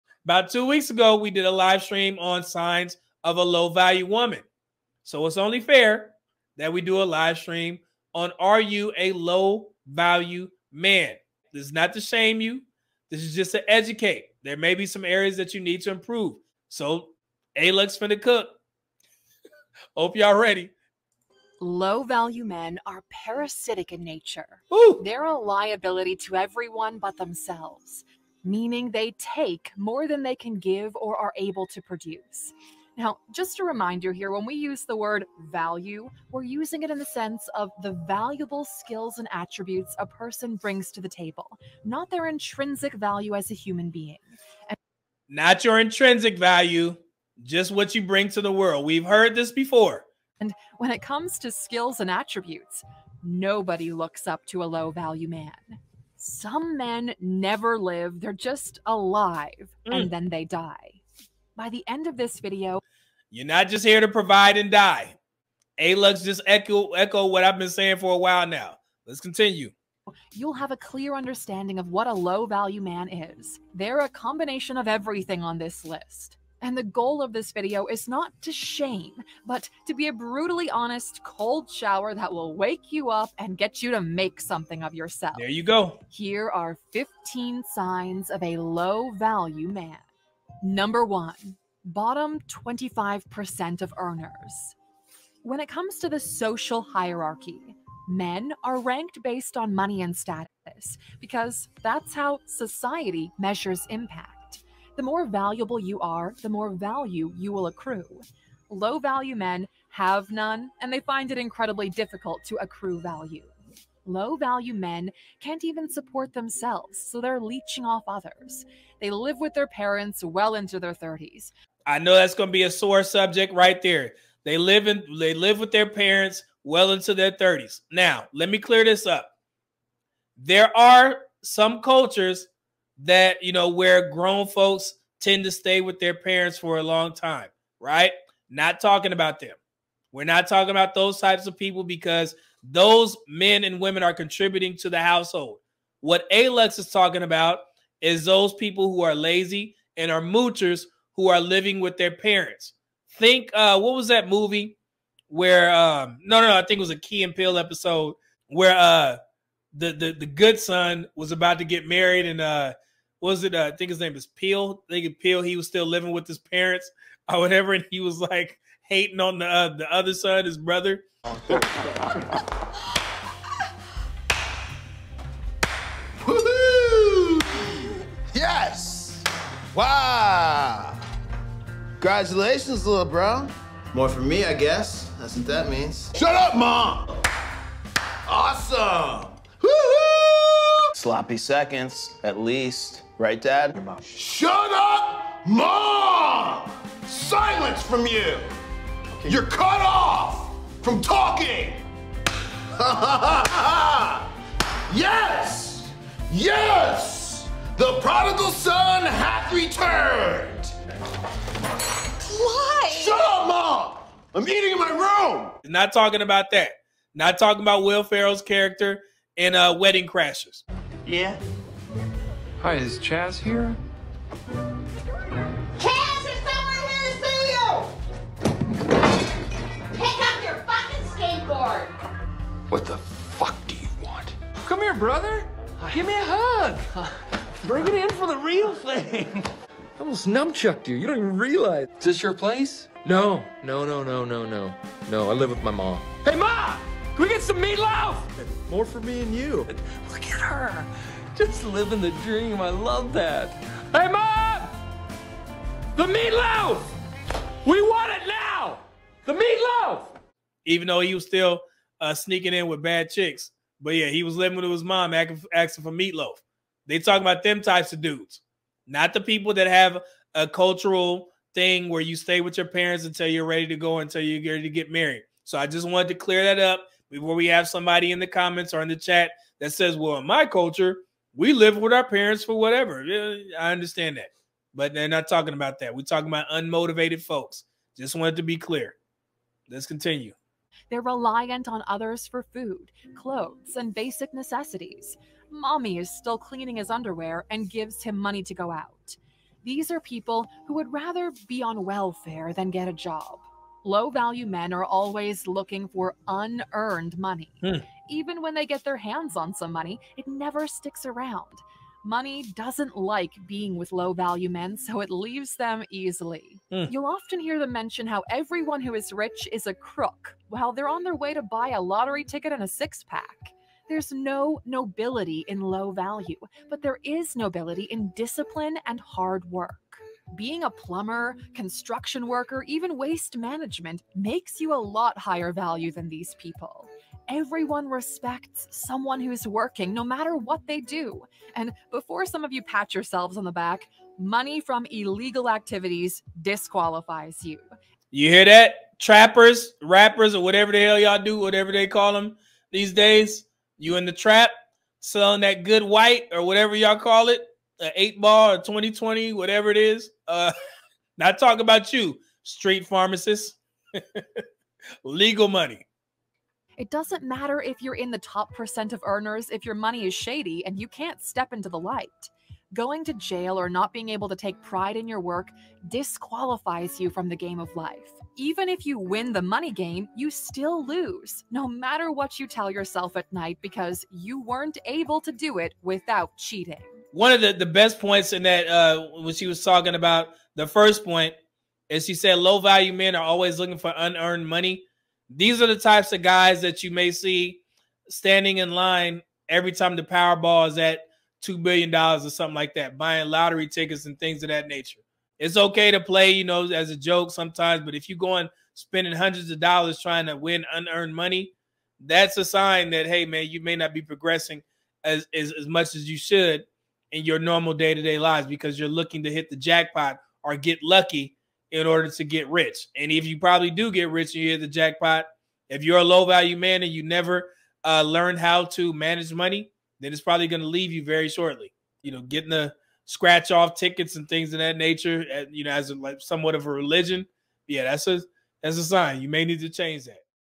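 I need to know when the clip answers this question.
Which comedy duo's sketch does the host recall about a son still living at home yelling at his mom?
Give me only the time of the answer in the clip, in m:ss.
2:36.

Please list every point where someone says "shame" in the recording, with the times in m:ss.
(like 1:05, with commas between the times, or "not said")
0:12, 1:18.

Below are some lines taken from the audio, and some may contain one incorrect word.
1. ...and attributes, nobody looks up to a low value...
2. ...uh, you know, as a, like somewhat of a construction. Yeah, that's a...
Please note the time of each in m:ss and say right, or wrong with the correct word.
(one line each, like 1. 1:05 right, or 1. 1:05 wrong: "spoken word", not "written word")
1. 0:52 right
2. 7:15 wrong: "religion", not "construction".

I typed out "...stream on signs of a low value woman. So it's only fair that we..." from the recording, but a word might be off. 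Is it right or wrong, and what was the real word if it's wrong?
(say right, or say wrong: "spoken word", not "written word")
right.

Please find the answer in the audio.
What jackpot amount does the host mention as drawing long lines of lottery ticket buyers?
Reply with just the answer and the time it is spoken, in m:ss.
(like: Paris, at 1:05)
$2 billion, at 6:41.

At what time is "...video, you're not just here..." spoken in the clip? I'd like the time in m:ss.
1:02.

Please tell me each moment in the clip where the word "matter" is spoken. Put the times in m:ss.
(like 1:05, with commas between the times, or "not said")
5:40, 6:07, 6:21.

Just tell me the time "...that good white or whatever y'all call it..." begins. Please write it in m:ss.
5:55.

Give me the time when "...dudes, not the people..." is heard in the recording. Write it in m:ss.
4:28.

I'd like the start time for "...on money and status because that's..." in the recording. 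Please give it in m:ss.
1:39.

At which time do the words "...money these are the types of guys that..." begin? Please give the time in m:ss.
6:34.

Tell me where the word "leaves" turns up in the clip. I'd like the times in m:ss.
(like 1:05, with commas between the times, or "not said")
5:15, 7:10.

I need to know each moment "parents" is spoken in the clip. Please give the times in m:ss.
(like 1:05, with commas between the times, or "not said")
1:59, 2:05, 2:16, 2:32, 2:46, 4:32, 4:42.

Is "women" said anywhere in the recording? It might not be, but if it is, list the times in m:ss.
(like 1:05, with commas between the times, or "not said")
2:23.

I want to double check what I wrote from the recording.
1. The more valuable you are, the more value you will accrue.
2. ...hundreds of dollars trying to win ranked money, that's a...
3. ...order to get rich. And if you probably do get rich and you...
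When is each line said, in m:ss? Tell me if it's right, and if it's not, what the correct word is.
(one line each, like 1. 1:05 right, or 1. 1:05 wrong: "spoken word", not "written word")
1. 1:45 right
2. 6:49 wrong: "unearned", not "ranked"
3. 7:01 right.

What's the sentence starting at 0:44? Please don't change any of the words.
And- not your intrinsic value, just what you bring to the world.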